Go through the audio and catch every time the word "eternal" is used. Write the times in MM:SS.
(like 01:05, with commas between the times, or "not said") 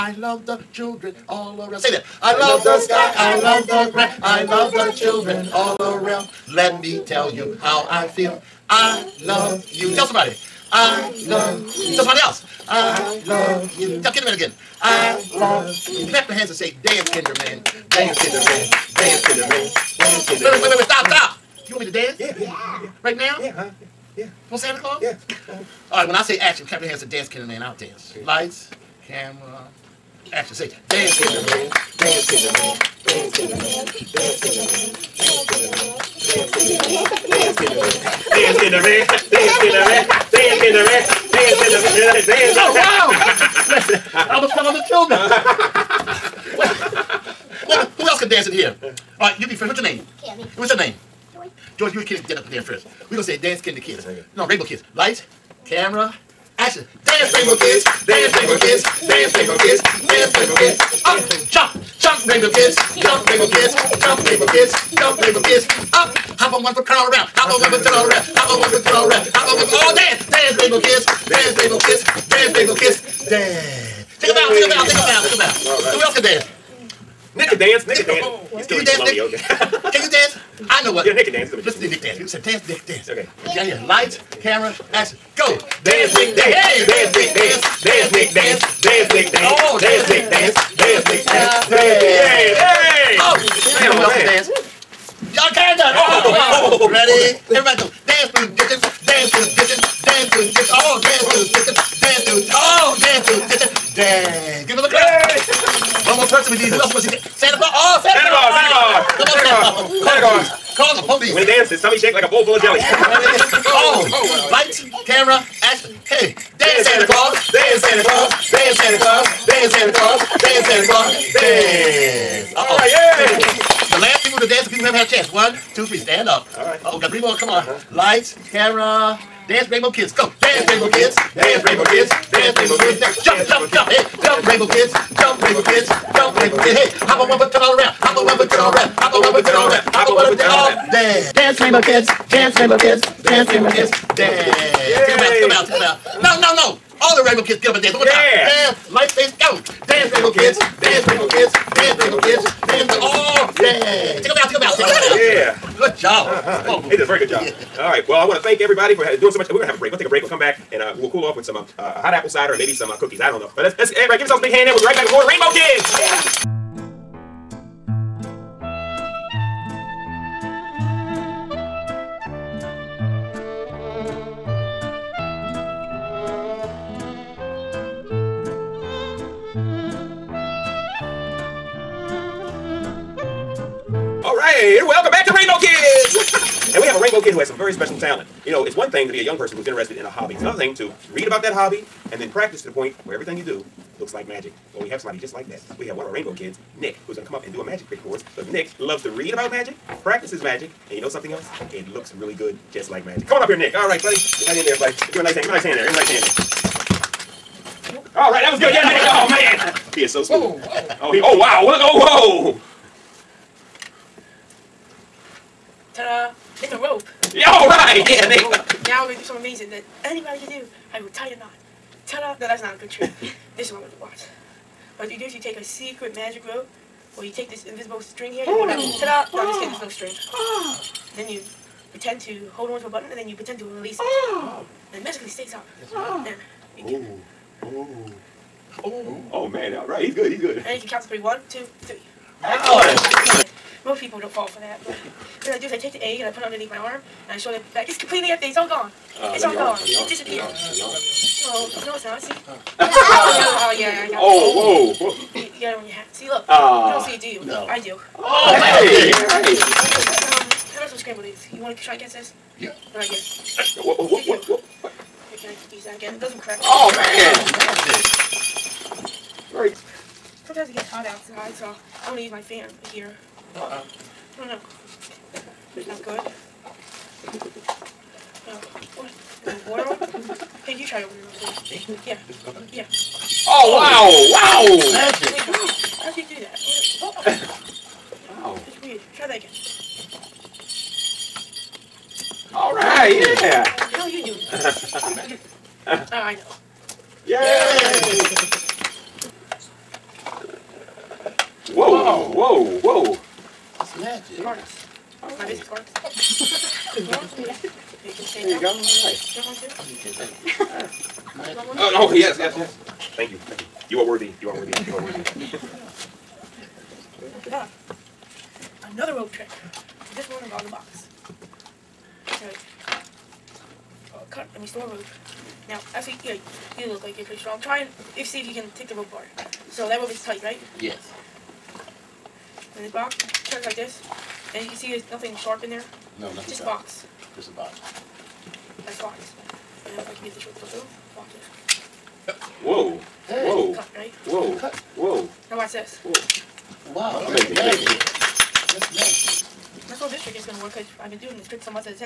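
not said.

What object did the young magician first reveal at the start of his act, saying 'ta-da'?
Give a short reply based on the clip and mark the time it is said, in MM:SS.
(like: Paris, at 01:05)
A rope, at 03:36.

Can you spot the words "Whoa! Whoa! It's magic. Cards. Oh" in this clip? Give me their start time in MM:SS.
05:02.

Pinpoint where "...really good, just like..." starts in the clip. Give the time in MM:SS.
03:22.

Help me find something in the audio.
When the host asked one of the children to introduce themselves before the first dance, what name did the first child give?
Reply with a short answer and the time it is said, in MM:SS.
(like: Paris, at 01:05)
Cammy, at 00:50.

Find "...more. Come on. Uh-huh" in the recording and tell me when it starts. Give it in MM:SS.
02:07.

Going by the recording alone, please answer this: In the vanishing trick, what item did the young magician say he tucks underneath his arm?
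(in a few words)
The egg.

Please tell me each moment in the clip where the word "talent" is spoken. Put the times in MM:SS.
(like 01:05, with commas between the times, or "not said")
03:07.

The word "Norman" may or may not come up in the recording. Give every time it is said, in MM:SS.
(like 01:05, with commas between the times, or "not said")
not said.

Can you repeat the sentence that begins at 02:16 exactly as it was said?
Hey, Hop on one foot, turn all around.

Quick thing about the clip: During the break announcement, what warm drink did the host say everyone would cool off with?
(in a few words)
hot apple cider.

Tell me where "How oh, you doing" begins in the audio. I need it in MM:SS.
04:53.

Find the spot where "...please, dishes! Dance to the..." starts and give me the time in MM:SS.
01:38.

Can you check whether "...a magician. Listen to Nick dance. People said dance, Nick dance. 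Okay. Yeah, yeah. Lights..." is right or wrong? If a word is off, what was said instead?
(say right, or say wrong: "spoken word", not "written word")
right.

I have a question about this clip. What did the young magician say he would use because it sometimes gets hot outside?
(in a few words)
My fan.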